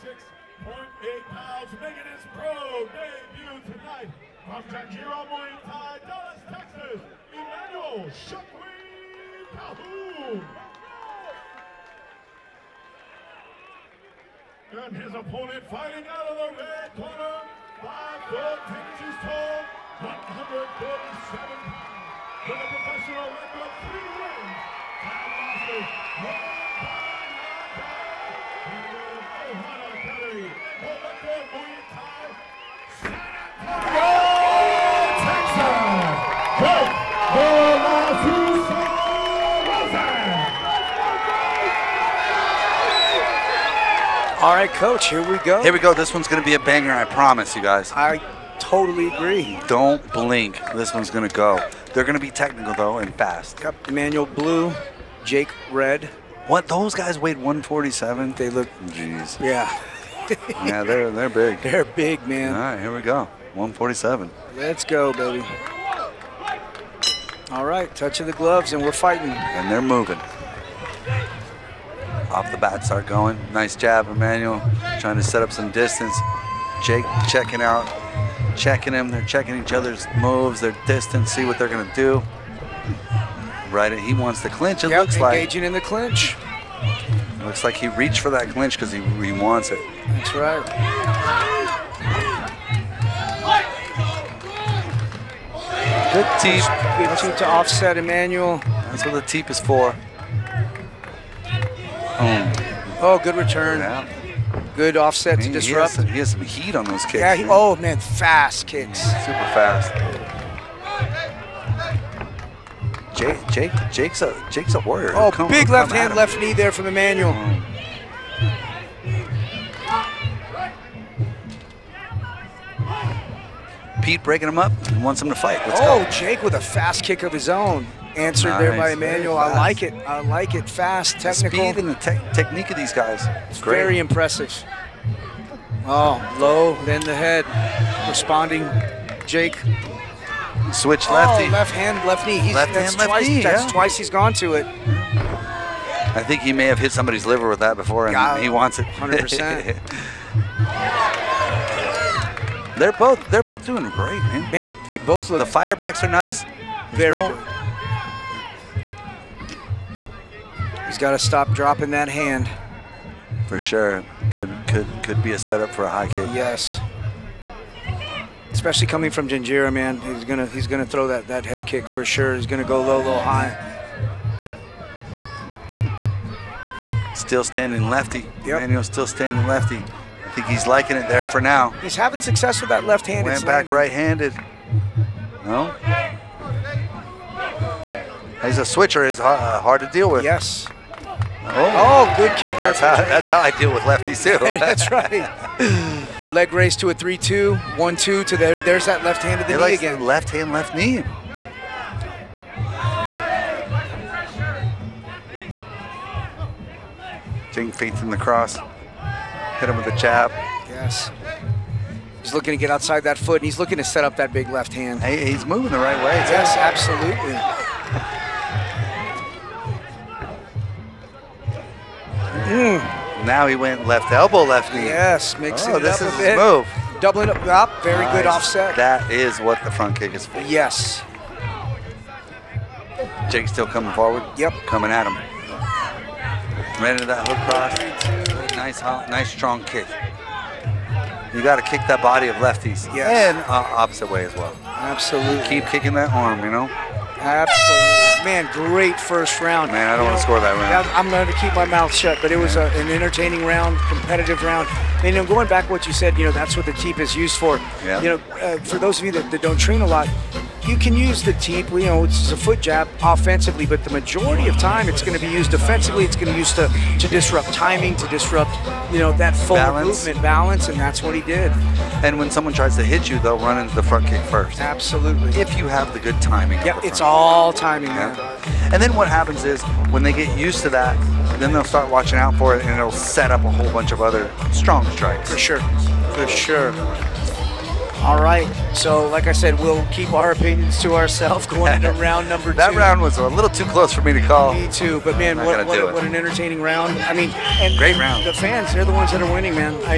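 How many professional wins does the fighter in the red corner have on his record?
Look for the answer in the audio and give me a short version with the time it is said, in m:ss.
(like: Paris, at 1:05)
3, at 0:23.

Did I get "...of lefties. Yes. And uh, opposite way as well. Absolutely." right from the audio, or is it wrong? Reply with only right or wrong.
right.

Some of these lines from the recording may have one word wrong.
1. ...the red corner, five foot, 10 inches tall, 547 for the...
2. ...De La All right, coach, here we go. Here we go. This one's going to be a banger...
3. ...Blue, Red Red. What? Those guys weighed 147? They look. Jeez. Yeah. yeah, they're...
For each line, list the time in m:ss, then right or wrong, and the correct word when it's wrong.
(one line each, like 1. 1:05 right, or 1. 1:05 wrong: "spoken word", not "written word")
1. 0:16 wrong: "147", not "547"
2. 0:44 right
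3. 0:54 wrong: "Jake", not "Red".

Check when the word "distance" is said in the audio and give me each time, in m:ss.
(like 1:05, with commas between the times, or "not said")
1:15, 1:20.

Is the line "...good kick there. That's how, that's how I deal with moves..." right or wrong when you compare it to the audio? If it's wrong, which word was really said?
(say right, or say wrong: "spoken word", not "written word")
wrong: "lefties", not "moves".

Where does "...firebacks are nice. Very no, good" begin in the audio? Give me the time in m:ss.
2:35.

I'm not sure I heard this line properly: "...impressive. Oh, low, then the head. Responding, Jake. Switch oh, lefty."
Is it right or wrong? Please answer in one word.
right.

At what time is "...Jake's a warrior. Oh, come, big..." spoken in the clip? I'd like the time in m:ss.
1:54.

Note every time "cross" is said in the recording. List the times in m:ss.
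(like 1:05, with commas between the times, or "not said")
3:28, 3:57.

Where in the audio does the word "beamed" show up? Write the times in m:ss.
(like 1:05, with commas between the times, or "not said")
not said.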